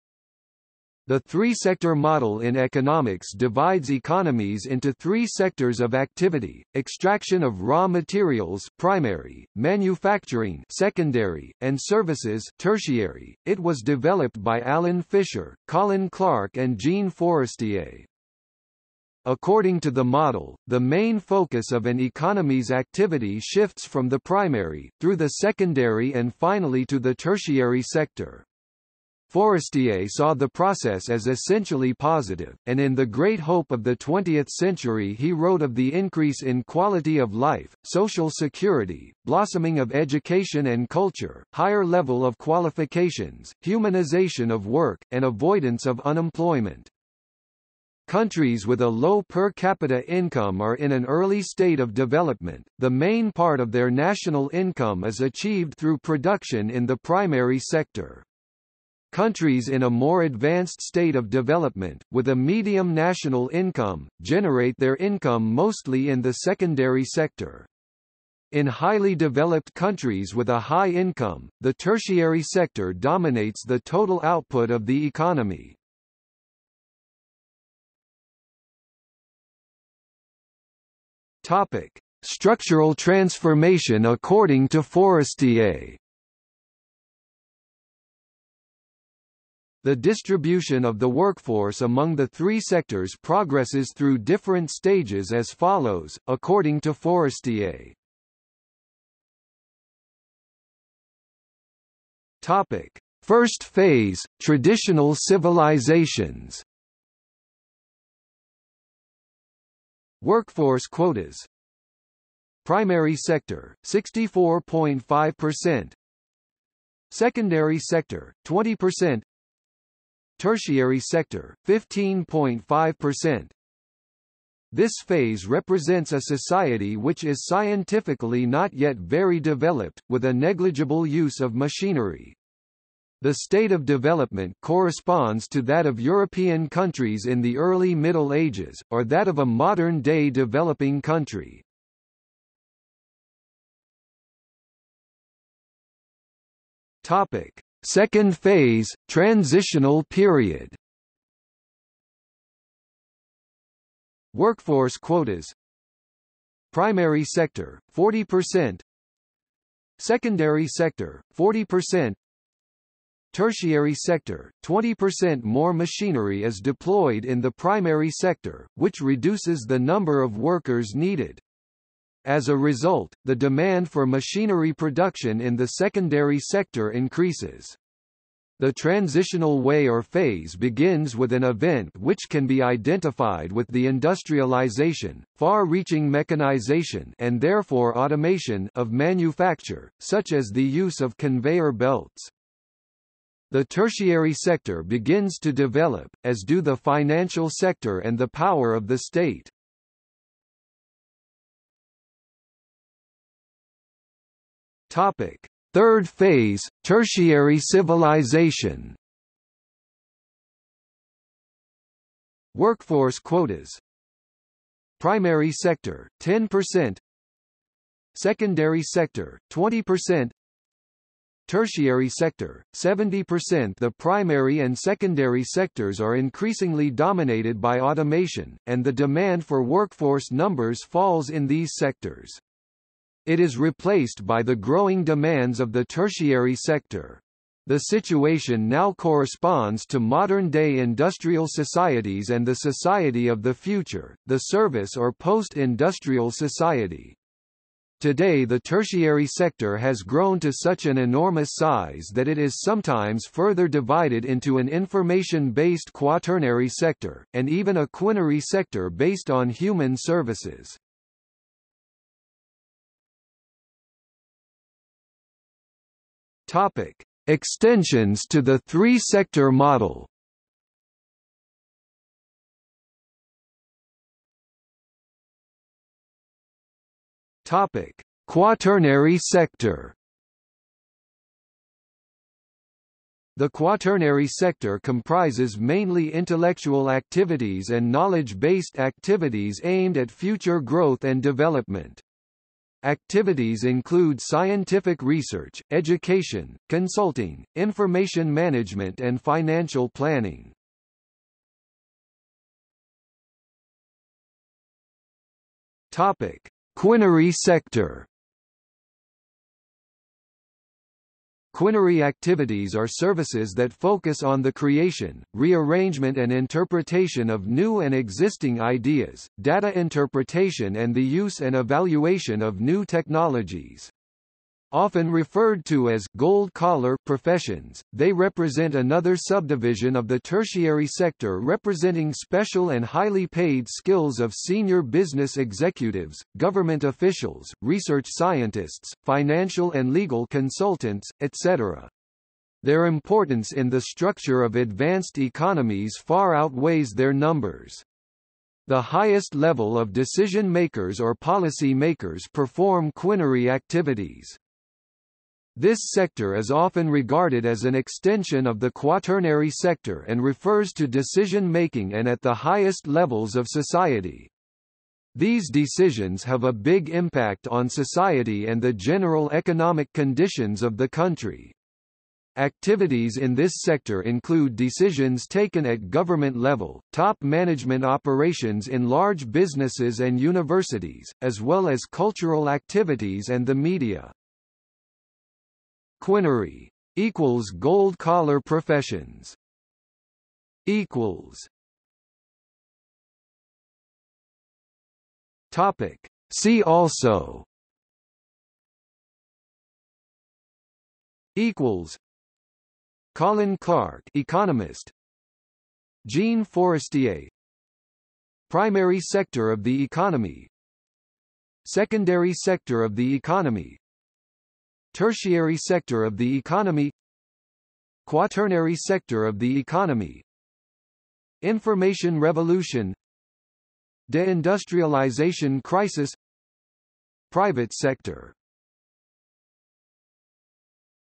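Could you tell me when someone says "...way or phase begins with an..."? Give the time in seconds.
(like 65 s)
179 s.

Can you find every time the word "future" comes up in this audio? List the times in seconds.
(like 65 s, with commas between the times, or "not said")
243 s, 290 s.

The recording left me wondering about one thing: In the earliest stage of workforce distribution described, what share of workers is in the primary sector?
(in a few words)
64.5%.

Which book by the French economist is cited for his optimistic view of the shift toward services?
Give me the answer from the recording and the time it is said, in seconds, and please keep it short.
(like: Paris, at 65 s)
The Great Hope of the Twentieth Century, at 32 s.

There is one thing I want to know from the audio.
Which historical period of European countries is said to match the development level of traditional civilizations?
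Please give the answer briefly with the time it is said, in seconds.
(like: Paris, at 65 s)
early Middle Ages, at 137 s.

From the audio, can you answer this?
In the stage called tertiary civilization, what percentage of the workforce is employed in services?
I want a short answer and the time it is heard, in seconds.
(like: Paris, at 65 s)
70%, at 222 s.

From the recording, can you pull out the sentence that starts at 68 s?
In highly developed countries with a high income, the tertiary sector dominates the total output of the economy.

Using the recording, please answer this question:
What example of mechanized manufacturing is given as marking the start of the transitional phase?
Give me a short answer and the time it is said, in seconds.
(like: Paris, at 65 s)
conveyor belts, at 191 s.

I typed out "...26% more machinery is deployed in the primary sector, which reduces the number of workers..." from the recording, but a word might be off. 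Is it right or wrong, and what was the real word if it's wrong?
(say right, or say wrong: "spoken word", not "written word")
wrong: "20", not "26".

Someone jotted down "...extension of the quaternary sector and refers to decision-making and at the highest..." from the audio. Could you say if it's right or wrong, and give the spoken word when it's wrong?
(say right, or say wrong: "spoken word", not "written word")
right.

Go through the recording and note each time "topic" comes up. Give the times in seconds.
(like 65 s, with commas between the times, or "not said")
81 s, 102 s, 147 s, 204 s, 266 s, 277 s, 305 s, 395 s.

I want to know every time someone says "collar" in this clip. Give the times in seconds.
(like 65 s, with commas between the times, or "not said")
326 s, 387 s.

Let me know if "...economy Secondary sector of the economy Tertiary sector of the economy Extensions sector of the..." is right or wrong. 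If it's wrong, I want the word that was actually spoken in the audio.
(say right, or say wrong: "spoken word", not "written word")
wrong: "Quaternary", not "Extensions".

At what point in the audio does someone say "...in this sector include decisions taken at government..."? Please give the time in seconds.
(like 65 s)
373 s.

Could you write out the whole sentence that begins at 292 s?
Activities include scientific research, education, consulting, information management and financial planning.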